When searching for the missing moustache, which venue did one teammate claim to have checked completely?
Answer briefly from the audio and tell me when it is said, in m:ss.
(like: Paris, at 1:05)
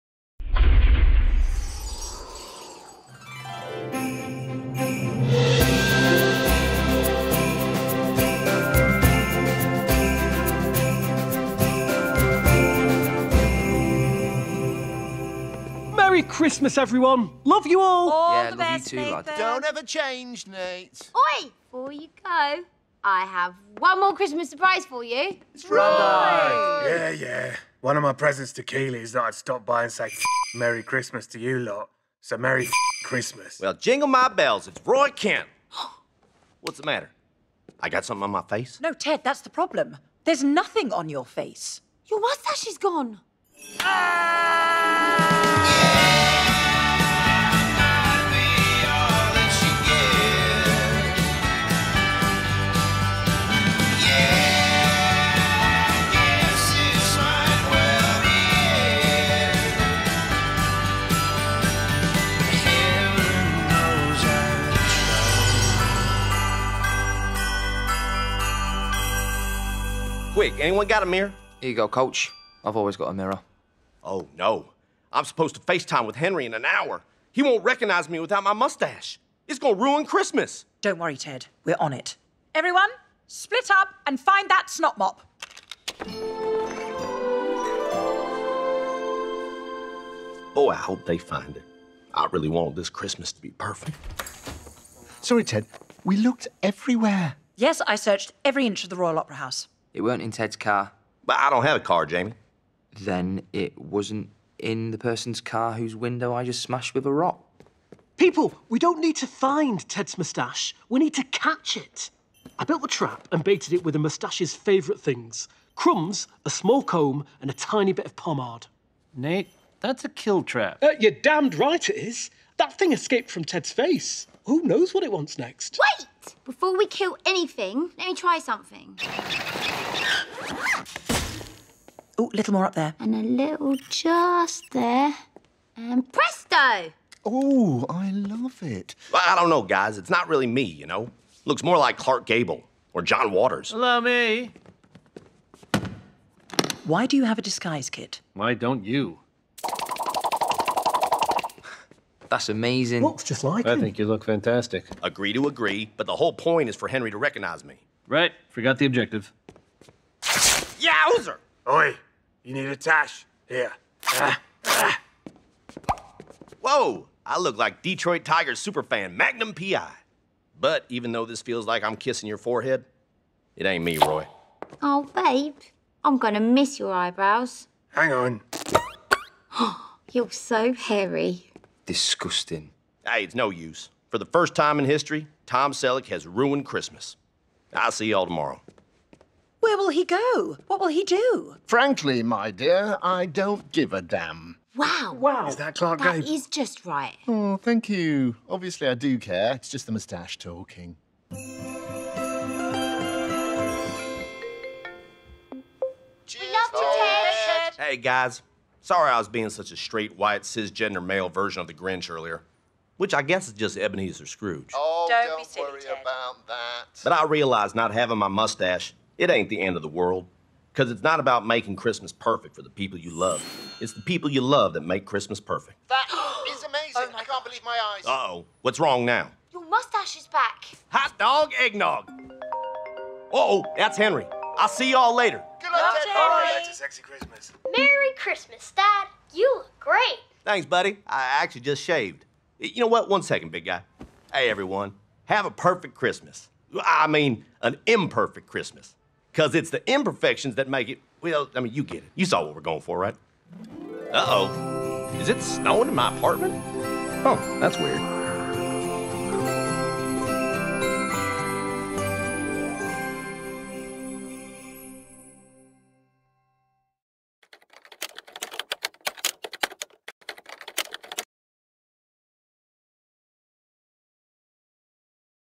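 Royal Opera House, at 1:38.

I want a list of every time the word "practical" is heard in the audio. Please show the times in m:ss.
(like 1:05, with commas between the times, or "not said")
not said.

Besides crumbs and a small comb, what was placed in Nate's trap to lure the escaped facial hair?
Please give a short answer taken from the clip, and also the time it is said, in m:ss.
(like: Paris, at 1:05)
pomade, at 1:58.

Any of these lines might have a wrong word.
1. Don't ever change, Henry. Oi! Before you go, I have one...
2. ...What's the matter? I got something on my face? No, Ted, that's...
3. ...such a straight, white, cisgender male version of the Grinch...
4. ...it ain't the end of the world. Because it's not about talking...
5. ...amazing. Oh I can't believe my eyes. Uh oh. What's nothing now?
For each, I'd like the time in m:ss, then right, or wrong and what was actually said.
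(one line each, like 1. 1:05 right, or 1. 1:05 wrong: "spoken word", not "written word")
1. 0:19 wrong: "Nate", not "Henry"
2. 0:36 right
3. 3:29 right
4. 3:39 wrong: "making", not "talking"
5. 3:46 wrong: "wrong", not "nothing".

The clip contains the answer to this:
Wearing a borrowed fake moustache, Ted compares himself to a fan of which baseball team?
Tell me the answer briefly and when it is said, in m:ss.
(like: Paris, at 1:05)
Detroit Tigers, at 2:47.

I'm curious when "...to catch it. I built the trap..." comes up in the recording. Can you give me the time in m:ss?
1:51.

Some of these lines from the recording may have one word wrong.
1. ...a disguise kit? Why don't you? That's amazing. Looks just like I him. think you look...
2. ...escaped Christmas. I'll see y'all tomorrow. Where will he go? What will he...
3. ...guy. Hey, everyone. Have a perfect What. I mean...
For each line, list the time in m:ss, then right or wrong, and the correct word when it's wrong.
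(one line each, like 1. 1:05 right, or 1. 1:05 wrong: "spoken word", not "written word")
1. 2:27 right
2. 3:06 wrong: "ruined", not "escaped"
3. 4:03 wrong: "Christmas", not "What".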